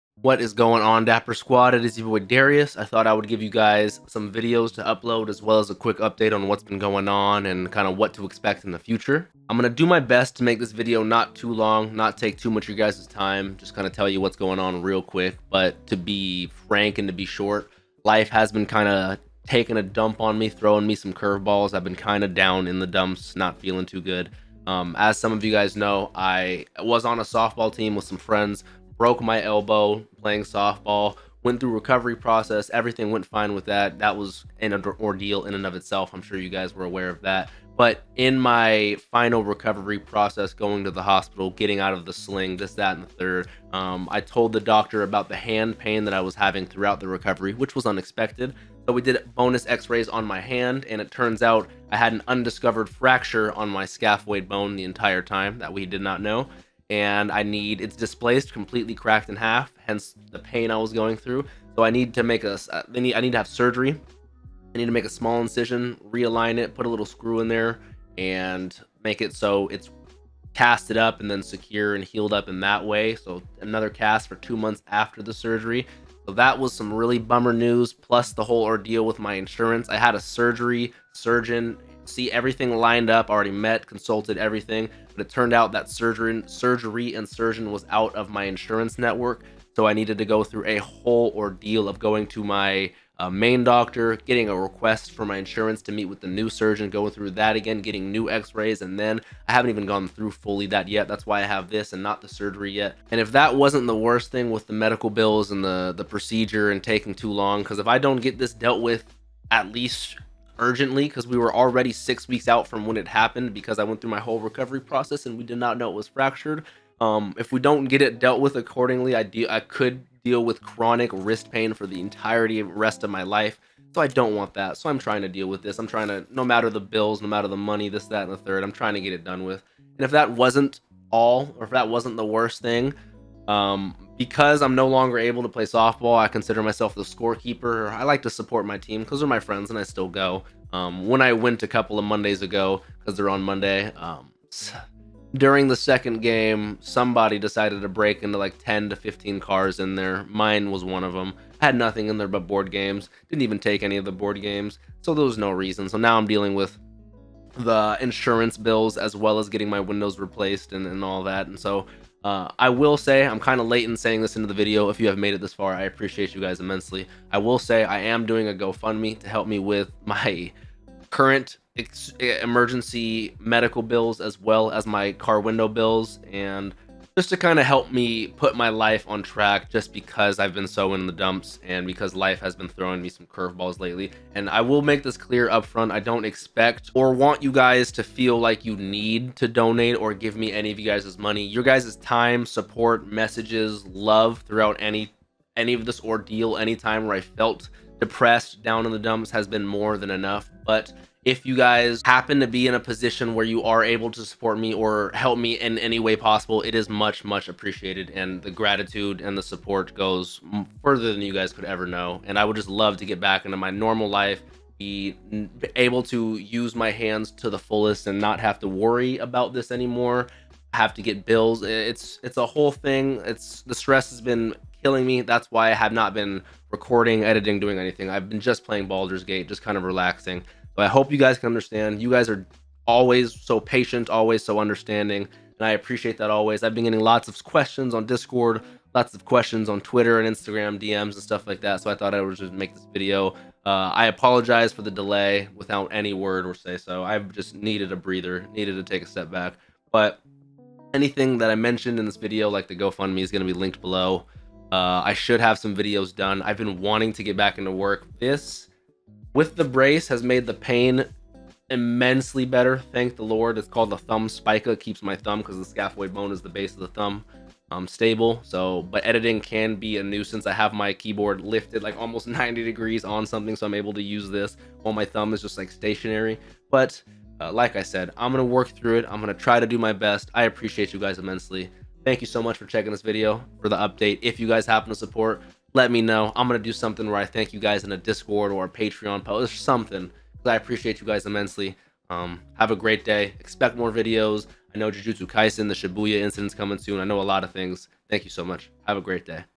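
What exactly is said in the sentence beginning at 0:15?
But to be frank and to be short, life has been kind of taking a dump on me, throwing me some curveballs.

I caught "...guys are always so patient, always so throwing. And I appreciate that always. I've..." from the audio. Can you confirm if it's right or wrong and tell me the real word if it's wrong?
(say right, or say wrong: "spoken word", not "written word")
wrong: "understanding", not "throwing".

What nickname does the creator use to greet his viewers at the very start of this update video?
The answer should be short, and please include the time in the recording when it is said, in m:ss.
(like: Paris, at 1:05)
Dapper Squad, at 0:01.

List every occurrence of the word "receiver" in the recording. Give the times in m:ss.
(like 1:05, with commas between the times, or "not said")
not said.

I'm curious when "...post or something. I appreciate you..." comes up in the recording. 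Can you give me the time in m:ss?
4:49.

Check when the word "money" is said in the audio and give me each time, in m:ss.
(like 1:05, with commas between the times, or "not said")
2:07, 3:11.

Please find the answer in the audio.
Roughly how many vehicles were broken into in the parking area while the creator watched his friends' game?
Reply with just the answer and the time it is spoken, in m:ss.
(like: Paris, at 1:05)
10 to 15, at 2:28.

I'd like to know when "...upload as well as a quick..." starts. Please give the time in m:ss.
0:04.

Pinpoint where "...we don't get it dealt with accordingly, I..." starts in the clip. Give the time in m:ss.
1:57.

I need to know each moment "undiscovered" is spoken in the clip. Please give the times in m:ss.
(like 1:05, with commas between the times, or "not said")
0:52.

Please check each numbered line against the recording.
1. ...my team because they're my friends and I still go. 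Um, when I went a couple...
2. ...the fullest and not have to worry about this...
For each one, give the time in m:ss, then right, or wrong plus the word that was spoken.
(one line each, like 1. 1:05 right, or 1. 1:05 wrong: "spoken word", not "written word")
1. 2:18 right
2. 3:37 right.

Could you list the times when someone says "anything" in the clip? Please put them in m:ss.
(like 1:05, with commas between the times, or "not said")
3:47, 4:10.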